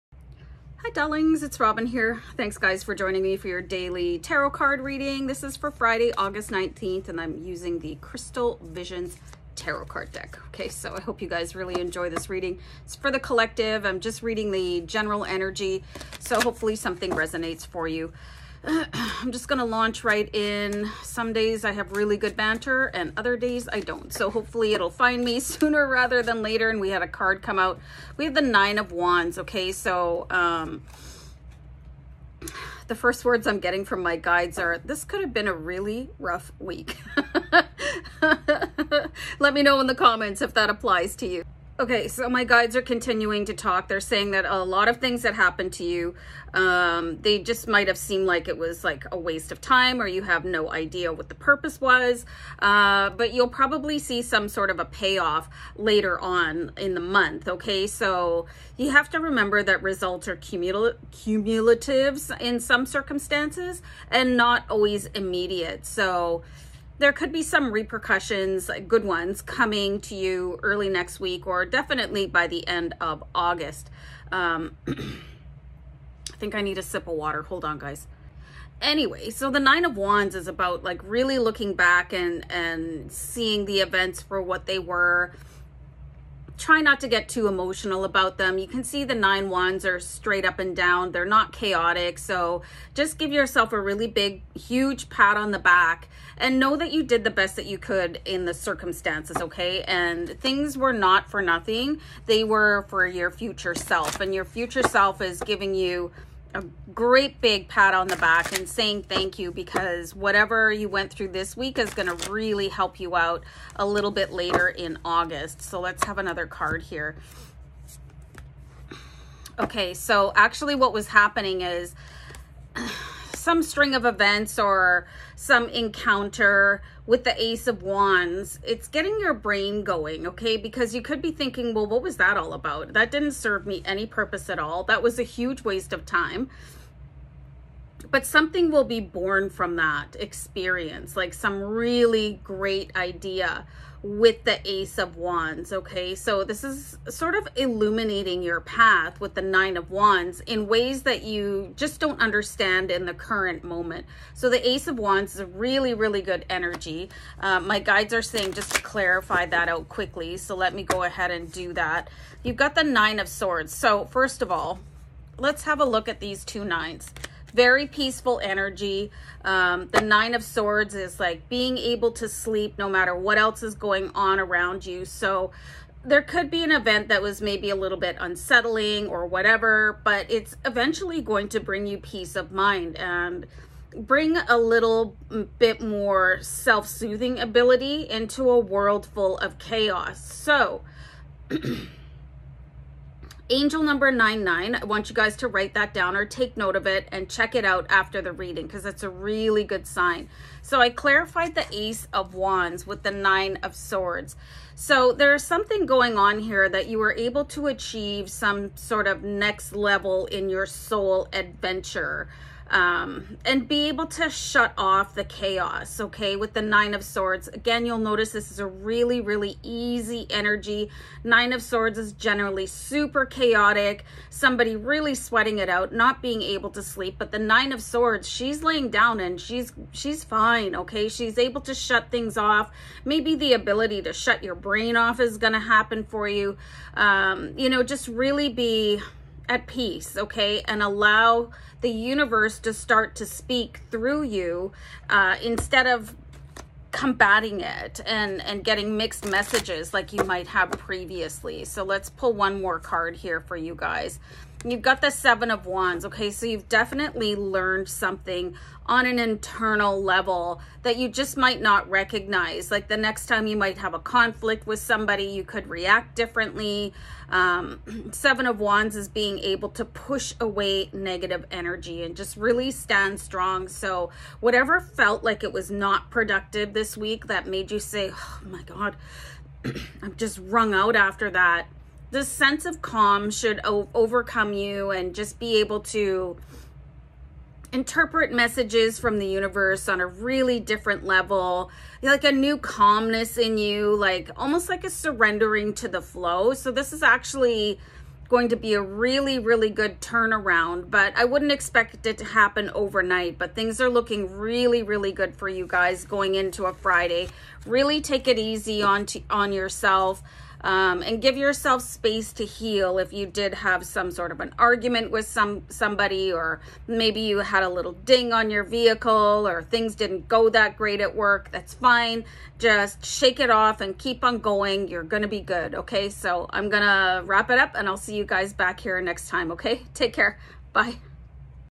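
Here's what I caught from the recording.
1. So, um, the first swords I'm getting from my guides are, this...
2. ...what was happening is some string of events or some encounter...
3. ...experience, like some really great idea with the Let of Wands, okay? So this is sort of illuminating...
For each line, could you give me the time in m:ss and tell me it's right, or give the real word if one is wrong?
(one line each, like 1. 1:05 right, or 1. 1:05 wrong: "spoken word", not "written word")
1. 0:29 wrong: "words", not "swords"
2. 2:00 right
3. 2:20 wrong: "Ace", not "Let".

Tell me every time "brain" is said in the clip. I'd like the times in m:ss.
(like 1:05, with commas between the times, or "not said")
2:09, 3:54.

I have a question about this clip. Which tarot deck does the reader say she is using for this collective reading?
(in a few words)
Crystal Visions.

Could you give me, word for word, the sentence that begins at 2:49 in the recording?
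Um, the Nine of Swords is like being able to sleep no matter what else is going on around you.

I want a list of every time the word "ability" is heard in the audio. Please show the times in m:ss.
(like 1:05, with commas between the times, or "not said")
3:07, 3:53.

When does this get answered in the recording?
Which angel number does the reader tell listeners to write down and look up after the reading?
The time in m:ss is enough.
3:14.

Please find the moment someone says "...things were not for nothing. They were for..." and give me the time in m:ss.
1:40.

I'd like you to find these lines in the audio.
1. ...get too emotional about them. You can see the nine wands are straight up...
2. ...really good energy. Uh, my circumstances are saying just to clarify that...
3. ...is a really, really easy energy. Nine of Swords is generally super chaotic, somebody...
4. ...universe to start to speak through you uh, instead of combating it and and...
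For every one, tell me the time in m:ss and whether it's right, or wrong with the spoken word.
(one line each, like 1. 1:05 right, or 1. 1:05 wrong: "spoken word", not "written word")
1. 1:27 right
2. 2:35 wrong: "guides", not "circumstances"
3. 3:38 right
4. 4:01 right.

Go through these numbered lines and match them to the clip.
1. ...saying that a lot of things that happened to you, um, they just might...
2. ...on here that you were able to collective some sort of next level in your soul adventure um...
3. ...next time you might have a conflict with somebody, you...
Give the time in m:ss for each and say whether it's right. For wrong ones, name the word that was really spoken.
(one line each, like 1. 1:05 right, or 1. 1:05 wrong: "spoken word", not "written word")
1. 0:44 right
2. 3:26 wrong: "achieve", not "collective"
3. 4:22 right.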